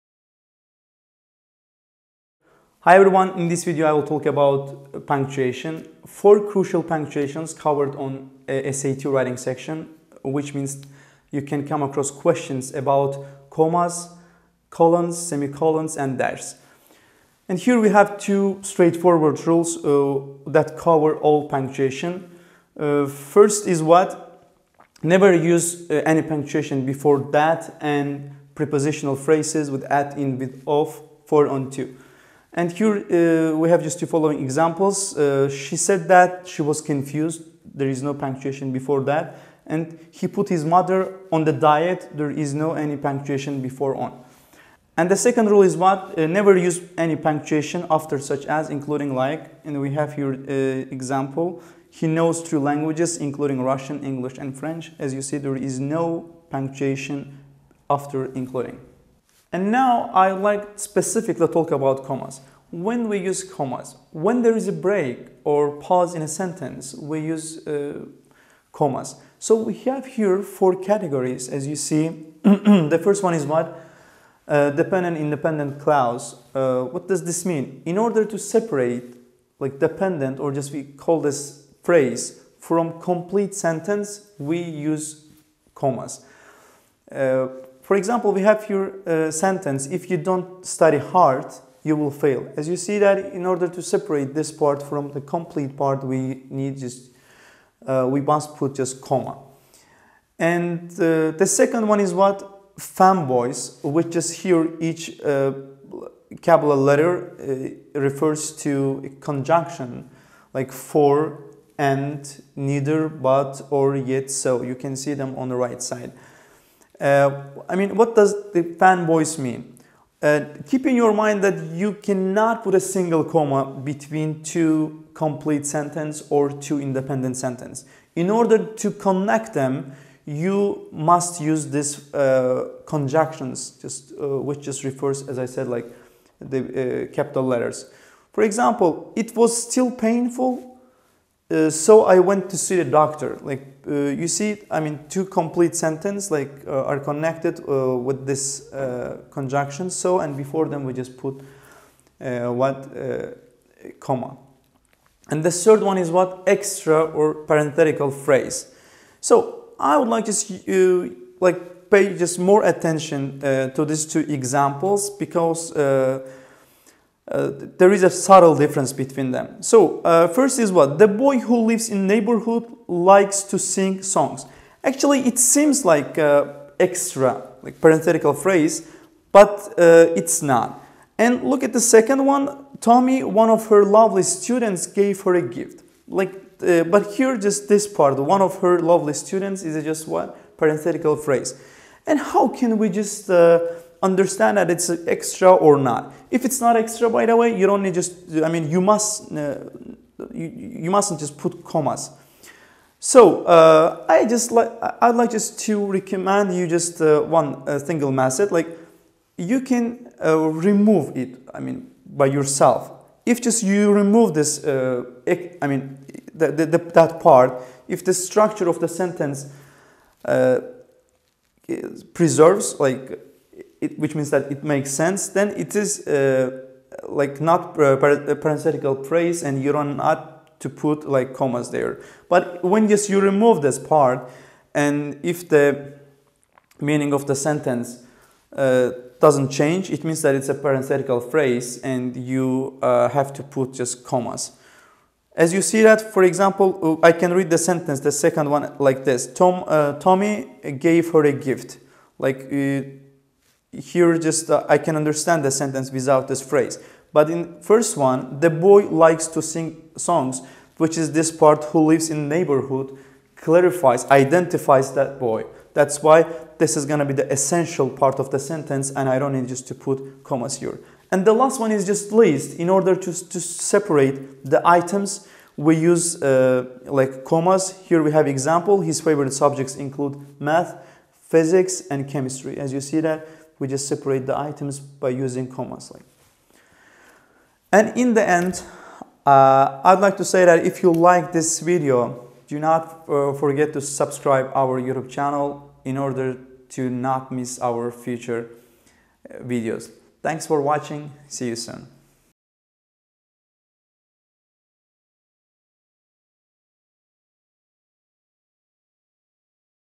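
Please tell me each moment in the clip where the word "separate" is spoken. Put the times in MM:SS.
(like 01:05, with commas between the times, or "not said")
01:18, 01:33, 04:33, 04:43.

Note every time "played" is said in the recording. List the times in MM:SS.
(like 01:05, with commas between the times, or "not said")
not said.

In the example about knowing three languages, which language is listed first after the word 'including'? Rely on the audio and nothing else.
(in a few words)
Russian.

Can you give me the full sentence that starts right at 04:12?
Like uh, here just uh, I can understand the sentence without this phrase.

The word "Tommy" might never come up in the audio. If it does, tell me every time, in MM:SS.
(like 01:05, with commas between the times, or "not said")
03:02, 04:09.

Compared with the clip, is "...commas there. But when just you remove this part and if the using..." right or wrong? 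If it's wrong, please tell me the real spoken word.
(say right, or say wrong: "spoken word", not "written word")
wrong: "meaning", not "using".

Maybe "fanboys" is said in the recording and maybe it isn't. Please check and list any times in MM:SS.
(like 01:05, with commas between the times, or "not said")
01:42, 01:58.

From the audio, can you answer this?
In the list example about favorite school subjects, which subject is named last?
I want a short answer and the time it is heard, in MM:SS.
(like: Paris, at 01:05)
chemistry, at 04:42.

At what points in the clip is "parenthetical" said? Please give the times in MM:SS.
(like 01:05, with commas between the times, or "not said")
02:37, 02:57, 03:10, 03:47, 04:00.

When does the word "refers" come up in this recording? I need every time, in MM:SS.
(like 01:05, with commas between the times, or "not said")
01:47, 02:14.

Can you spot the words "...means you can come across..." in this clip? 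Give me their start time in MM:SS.
00:10.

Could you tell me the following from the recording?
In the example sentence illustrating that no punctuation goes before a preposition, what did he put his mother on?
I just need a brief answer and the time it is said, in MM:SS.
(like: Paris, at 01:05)
the diet, at 00:41.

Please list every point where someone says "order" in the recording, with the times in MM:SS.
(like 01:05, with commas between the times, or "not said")
01:17, 01:33, 02:08, 04:32, 04:55.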